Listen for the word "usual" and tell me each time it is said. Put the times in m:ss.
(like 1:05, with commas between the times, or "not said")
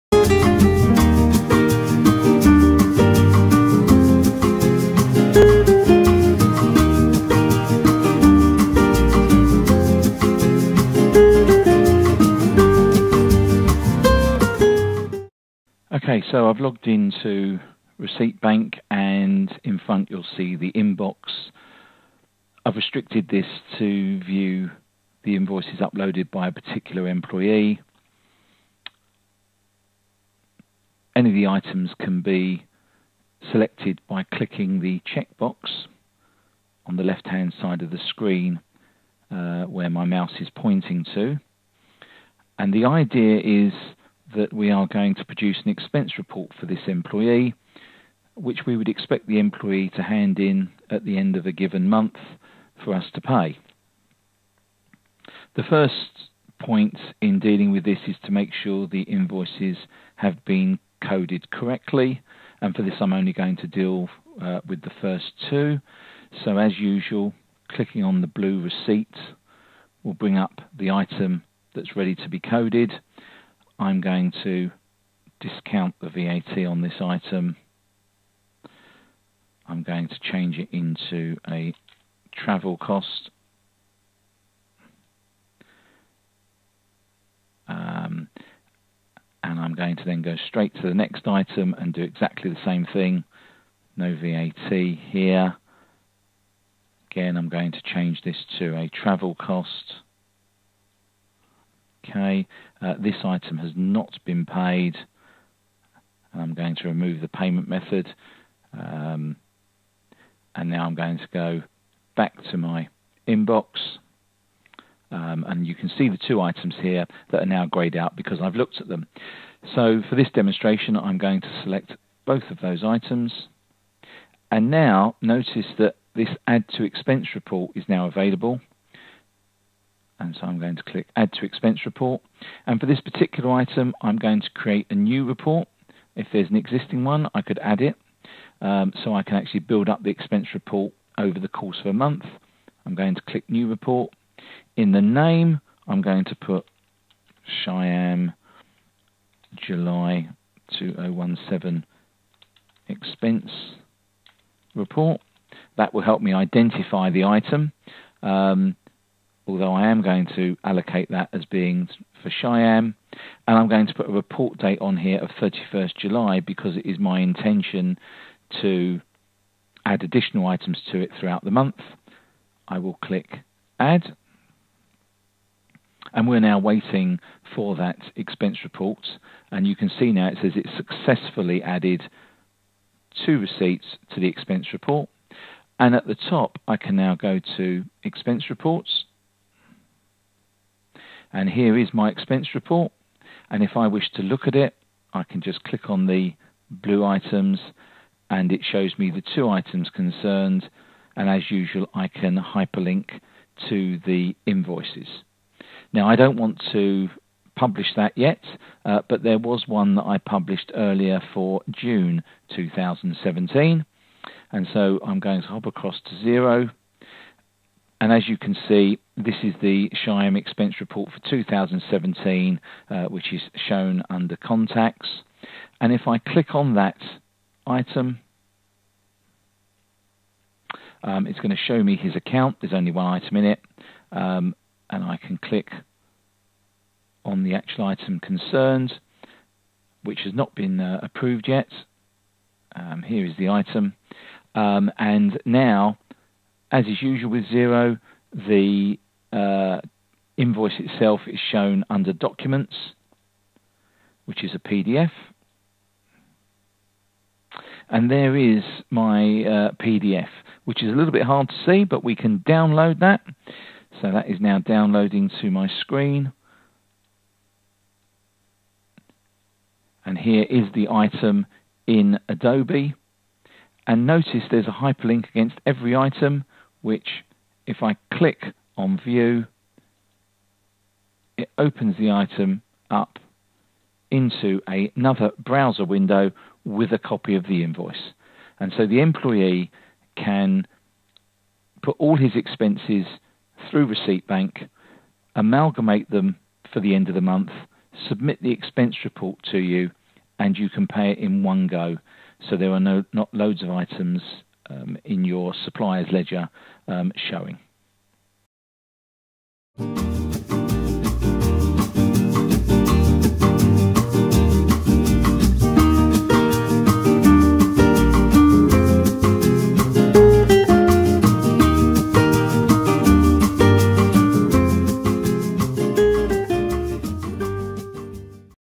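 1:06, 3:21, 4:07.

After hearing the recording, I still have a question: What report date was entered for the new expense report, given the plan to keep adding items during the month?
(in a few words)
31st July.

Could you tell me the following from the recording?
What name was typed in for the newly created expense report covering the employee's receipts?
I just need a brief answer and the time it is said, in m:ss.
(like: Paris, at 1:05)
Cheyenne July 2017 expense report, at 2:27.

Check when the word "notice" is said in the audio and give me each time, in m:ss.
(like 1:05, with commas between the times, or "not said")
2:05, 4:34.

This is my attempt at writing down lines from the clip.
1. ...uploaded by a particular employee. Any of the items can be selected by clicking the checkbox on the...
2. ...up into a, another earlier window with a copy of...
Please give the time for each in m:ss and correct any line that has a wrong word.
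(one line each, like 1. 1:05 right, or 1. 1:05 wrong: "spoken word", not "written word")
1. 0:25 right
2. 4:42 wrong: "browser", not "earlier".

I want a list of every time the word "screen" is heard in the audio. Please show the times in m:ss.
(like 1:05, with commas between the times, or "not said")
0:38, 4:25.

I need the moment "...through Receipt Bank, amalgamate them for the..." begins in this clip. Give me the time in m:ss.
4:53.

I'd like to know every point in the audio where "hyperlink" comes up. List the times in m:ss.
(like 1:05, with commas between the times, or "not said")
3:22, 4:34.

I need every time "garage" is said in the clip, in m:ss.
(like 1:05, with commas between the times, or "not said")
not said.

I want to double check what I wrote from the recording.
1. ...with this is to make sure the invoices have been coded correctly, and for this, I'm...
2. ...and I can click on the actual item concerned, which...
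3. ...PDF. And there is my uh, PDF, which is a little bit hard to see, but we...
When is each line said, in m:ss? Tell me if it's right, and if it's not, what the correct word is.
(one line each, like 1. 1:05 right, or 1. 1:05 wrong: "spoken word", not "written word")
1. 0:57 right
2. 3:54 right
3. 4:14 right.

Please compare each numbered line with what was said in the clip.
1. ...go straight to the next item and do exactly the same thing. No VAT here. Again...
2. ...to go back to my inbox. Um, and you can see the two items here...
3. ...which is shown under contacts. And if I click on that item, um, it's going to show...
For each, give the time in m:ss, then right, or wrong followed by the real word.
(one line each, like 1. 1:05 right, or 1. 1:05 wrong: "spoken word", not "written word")
1. 1:30 right
2. 1:51 right
3. 3:43 right.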